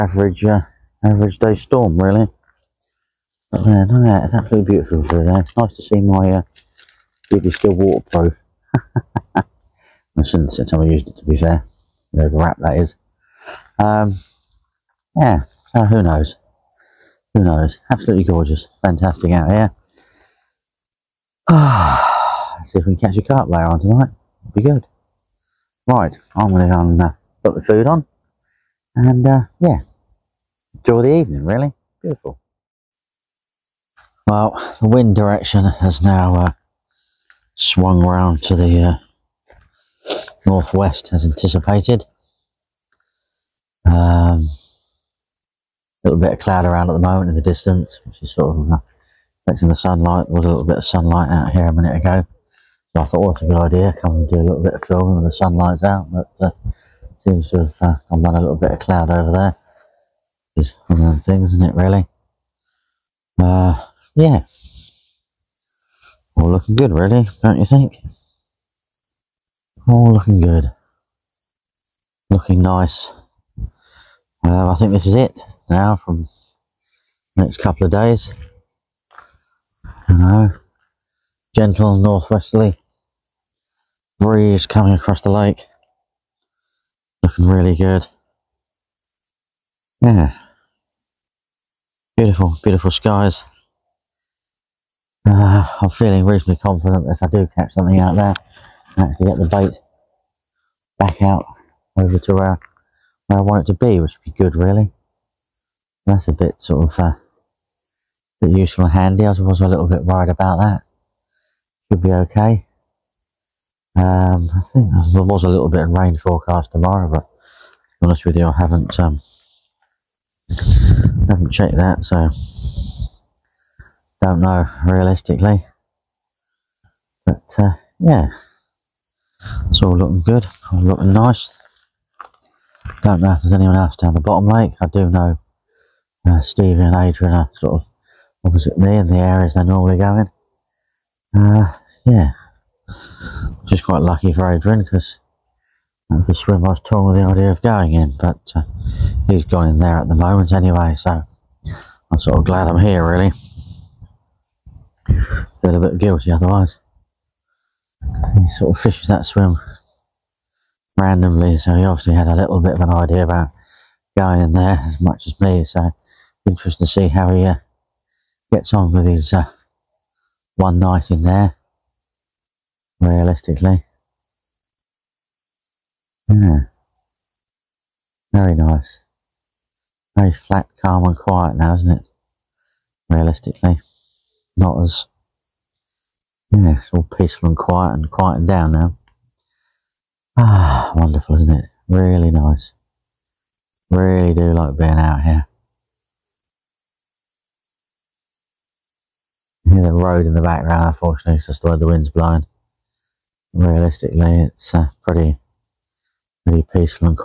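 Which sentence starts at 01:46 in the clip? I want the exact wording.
That's a bit sort of uh, bit useful and handy.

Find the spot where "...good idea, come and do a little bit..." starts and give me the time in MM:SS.
00:53.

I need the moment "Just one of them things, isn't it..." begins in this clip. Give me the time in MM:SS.
01:00.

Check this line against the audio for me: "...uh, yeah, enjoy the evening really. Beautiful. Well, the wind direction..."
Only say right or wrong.
right.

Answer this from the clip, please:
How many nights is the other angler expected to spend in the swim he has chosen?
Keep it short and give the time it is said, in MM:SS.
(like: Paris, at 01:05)
1, at 02:50.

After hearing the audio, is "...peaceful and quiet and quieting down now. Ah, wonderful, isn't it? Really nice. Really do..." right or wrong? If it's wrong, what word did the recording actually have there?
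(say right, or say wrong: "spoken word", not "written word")
right.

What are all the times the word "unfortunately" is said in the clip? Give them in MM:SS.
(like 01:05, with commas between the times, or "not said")
03:20.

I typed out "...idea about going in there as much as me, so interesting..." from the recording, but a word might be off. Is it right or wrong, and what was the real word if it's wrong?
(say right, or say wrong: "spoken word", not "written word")
right.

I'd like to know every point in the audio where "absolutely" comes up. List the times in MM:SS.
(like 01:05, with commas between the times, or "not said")
00:04, 00:17.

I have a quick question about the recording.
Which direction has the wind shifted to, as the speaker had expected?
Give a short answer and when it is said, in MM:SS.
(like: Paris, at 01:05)
Northwest, at 00:40.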